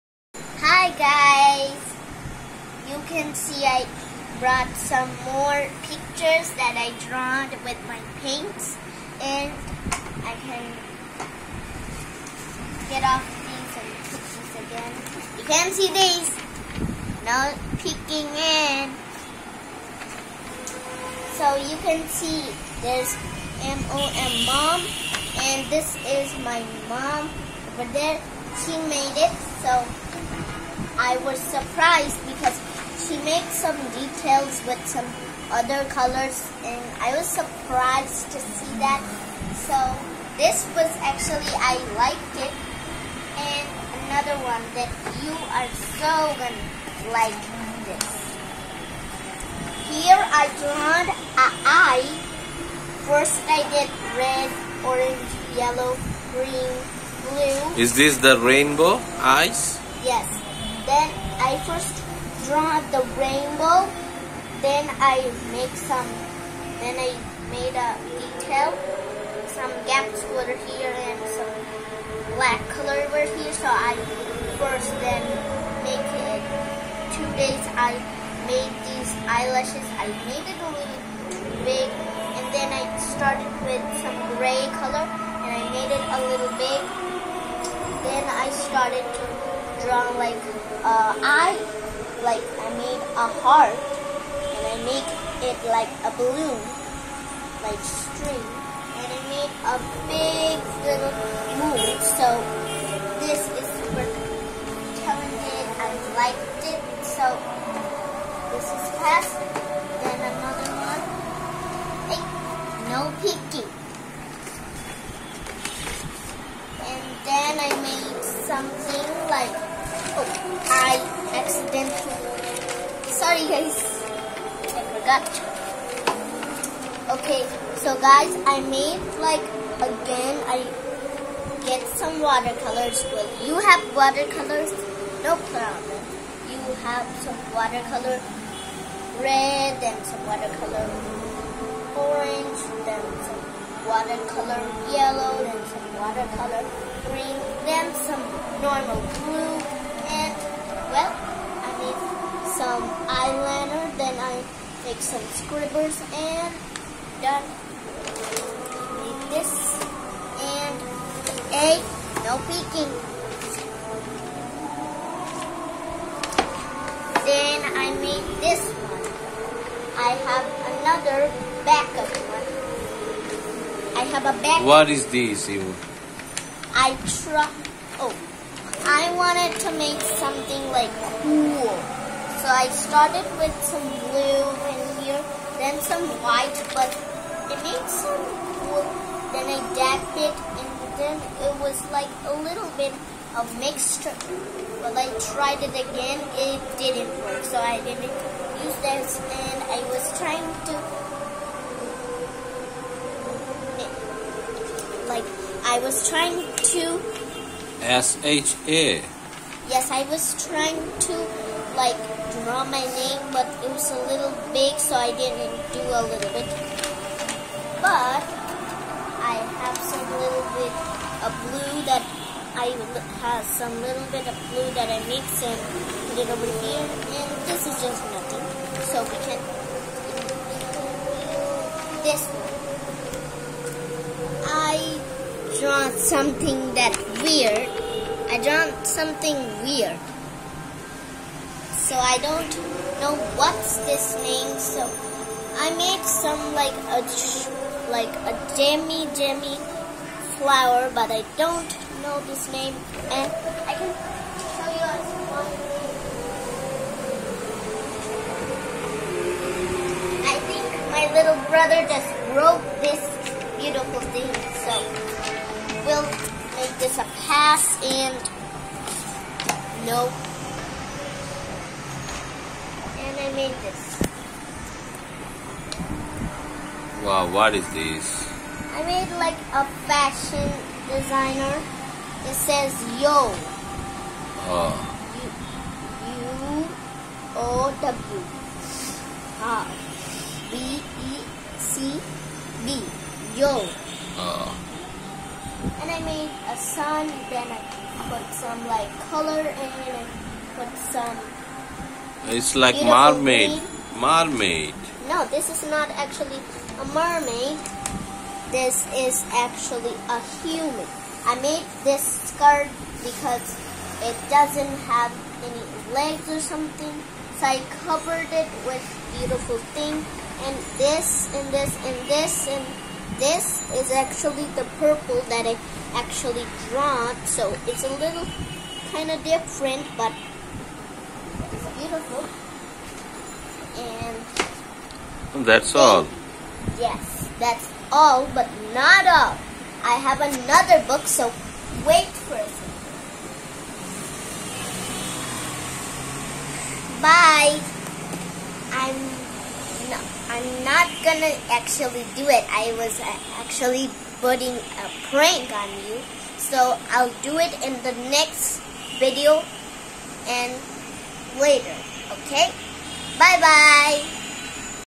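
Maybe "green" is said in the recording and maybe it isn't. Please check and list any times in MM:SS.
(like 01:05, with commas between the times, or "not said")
00:56, 02:27, 05:03.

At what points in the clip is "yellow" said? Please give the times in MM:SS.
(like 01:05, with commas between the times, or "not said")
00:55, 02:24.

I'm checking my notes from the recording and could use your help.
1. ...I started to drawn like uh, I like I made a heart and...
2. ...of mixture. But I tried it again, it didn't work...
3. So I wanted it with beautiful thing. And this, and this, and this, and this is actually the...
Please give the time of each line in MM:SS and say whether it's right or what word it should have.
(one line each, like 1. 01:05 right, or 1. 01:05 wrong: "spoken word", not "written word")
1. 01:28 right
2. 03:13 right
3. 05:17 wrong: "covered", not "wanted".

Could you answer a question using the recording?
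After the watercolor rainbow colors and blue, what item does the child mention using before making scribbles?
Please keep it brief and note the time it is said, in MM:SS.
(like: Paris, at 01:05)
Eyeliner, at 02:33.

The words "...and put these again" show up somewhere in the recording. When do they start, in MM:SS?
00:13.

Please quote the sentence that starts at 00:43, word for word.
And another one that you are so gonna like this.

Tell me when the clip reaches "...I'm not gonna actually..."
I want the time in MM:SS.
05:50.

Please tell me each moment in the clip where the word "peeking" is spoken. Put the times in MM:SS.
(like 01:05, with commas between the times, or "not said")
00:17, 02:42.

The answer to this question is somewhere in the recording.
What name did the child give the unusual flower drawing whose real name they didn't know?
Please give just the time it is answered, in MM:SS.
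04:08.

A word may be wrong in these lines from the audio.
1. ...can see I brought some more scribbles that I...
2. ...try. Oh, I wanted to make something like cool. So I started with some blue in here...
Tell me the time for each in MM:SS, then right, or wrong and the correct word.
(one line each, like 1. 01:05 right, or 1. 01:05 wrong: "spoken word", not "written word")
1. 00:03 wrong: "pictures", not "scribbles"
2. 02:57 right.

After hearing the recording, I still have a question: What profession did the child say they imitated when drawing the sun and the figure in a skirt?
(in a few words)
Fashion designer.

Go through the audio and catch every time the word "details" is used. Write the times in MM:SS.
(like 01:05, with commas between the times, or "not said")
00:33, 01:08.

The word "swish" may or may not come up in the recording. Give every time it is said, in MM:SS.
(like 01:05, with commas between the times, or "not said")
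not said.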